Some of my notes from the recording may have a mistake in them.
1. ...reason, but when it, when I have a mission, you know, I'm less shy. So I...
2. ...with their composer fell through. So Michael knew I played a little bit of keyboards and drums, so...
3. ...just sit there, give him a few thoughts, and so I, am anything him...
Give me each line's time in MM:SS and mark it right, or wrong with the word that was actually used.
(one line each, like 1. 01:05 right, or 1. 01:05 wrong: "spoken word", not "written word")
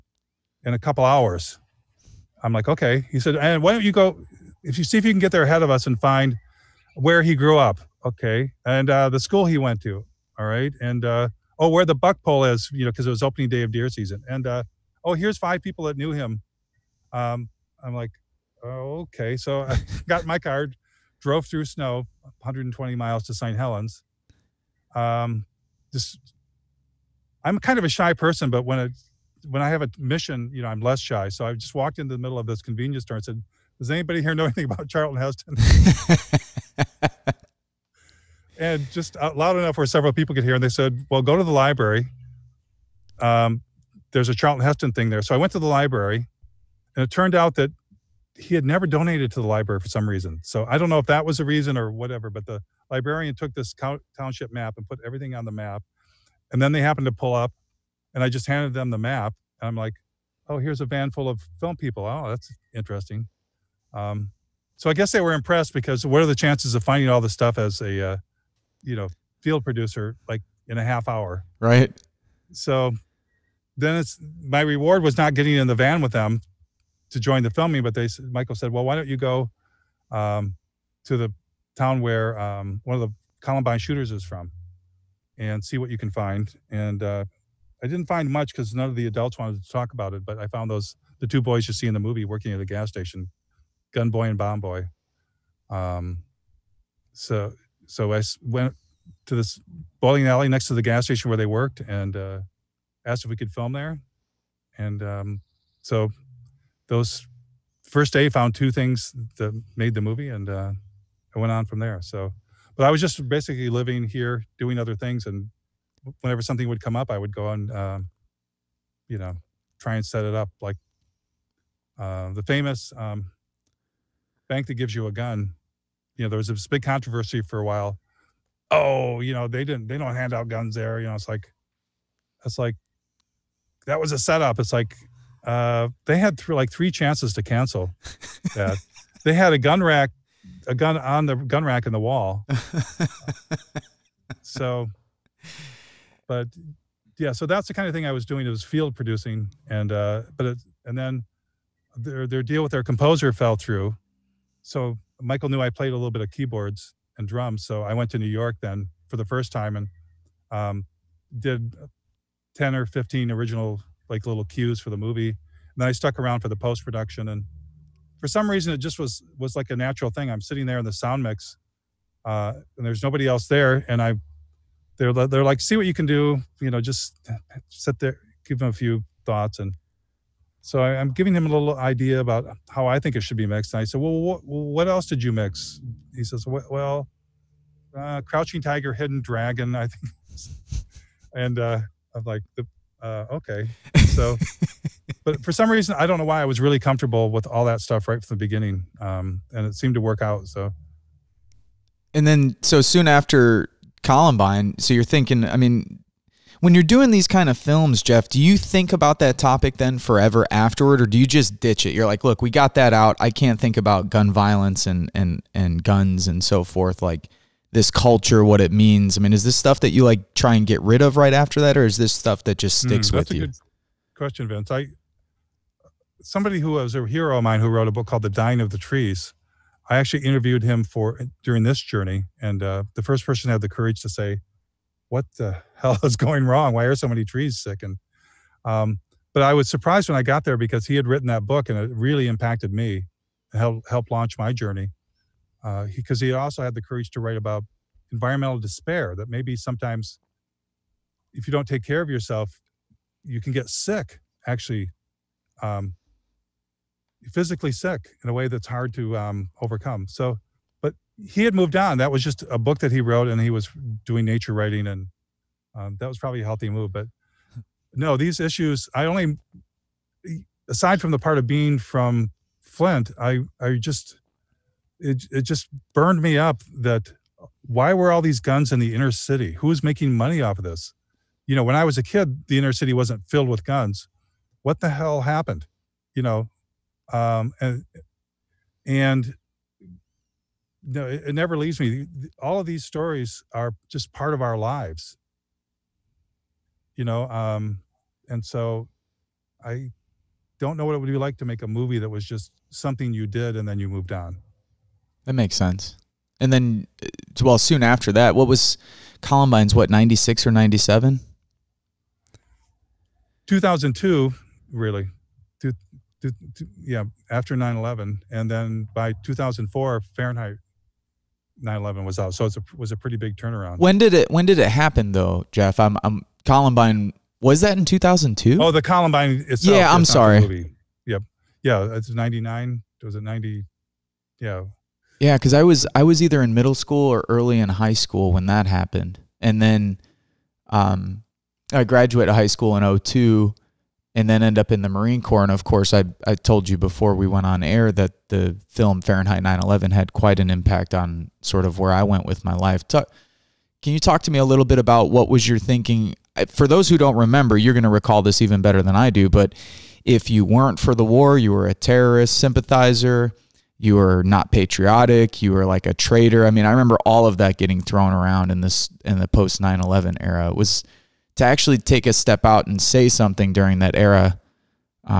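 1. 00:28 wrong: "person", not "reason"
2. 02:32 right
3. 02:56 wrong: "giving", not "anything".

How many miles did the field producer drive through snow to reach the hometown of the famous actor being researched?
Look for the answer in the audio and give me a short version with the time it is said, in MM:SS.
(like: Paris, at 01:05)
120, at 00:22.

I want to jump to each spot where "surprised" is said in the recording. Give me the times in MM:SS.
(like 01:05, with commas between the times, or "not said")
03:59.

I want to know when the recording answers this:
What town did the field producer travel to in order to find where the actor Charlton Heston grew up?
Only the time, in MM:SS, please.
00:23.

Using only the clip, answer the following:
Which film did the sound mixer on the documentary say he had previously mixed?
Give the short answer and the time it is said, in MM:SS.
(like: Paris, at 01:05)
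Crouching Tiger, Hidden Dragon, at 03:08.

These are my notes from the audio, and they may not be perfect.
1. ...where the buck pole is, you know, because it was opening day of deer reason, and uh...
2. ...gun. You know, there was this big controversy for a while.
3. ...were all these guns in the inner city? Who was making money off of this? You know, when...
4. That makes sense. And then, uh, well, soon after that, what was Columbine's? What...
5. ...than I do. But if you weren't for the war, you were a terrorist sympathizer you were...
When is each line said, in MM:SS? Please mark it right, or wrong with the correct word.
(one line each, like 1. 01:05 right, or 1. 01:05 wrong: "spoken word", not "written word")
1. 00:11 wrong: "season", not "reason"
2. 02:05 right
3. 04:37 right
4. 05:05 right
5. 05:58 right.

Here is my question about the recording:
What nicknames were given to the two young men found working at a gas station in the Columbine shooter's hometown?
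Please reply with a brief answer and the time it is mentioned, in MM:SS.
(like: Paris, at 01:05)
Gun Boy and Bomb Boy, at 01:33.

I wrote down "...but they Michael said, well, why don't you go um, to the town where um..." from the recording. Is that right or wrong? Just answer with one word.
right.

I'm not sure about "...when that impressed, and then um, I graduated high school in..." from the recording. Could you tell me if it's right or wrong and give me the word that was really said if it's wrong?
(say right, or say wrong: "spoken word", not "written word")
wrong: "happened", not "impressed".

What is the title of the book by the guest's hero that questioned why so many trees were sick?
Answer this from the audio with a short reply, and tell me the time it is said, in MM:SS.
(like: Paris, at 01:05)
The Dying of the Trees, at 03:48.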